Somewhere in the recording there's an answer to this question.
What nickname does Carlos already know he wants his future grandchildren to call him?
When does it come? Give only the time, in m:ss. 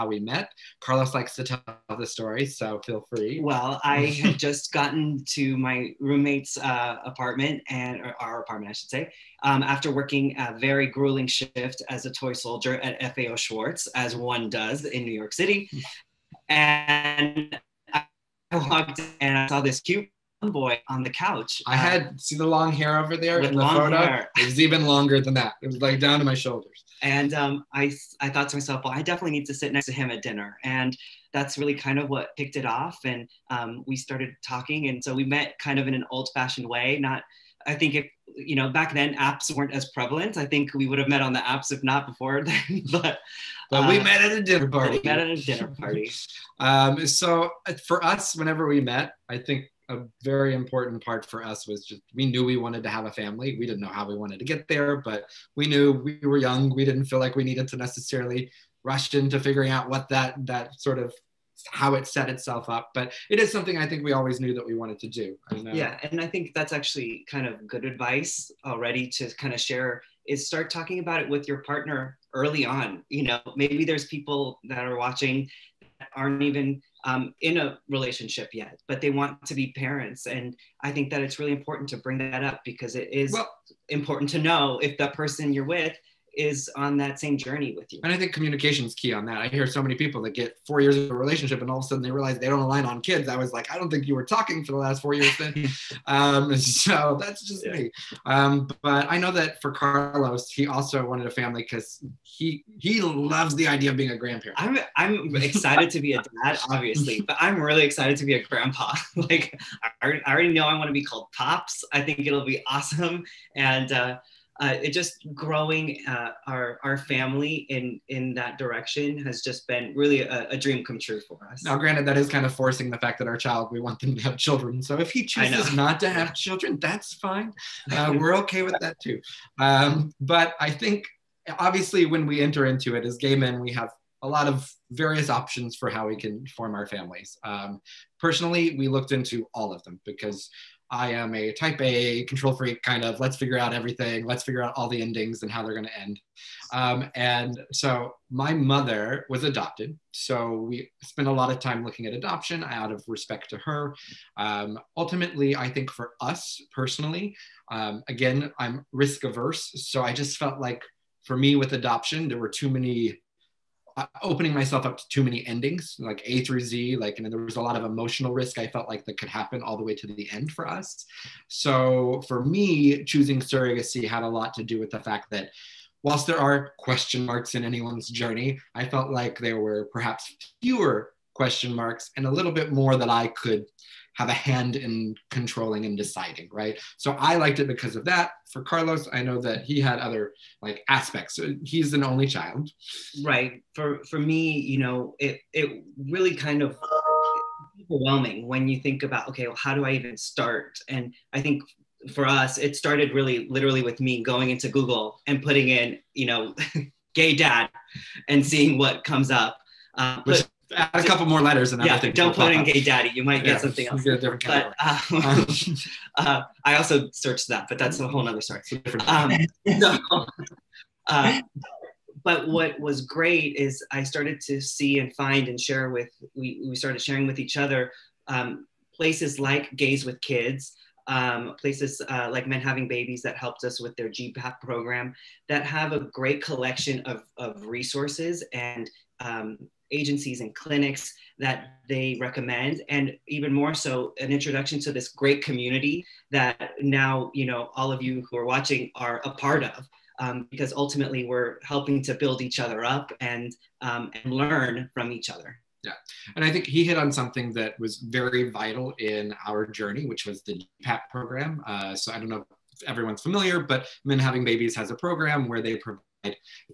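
1:51.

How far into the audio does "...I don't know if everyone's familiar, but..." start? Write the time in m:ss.
4:22.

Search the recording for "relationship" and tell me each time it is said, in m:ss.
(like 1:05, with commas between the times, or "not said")
1:17, 1:31.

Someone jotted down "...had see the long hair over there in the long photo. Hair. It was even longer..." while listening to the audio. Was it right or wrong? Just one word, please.
right.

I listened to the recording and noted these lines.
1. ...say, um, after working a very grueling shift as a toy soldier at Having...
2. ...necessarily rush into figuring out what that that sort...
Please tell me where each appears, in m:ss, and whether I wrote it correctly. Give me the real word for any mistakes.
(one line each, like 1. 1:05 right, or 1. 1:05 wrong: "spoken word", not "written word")
1. 0:08 wrong: "FAO", not "Having"
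2. 0:57 right.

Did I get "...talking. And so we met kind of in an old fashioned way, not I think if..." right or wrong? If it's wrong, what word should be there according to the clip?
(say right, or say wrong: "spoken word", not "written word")
right.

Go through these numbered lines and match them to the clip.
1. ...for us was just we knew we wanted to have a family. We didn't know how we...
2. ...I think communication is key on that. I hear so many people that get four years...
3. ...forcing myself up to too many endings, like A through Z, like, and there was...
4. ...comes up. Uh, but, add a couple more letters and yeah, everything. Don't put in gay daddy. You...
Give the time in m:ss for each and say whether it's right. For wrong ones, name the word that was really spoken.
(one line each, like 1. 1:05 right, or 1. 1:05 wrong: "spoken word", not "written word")
1. 0:51 right
2. 1:28 right
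3. 2:44 wrong: "opening", not "forcing"
4. 3:29 right.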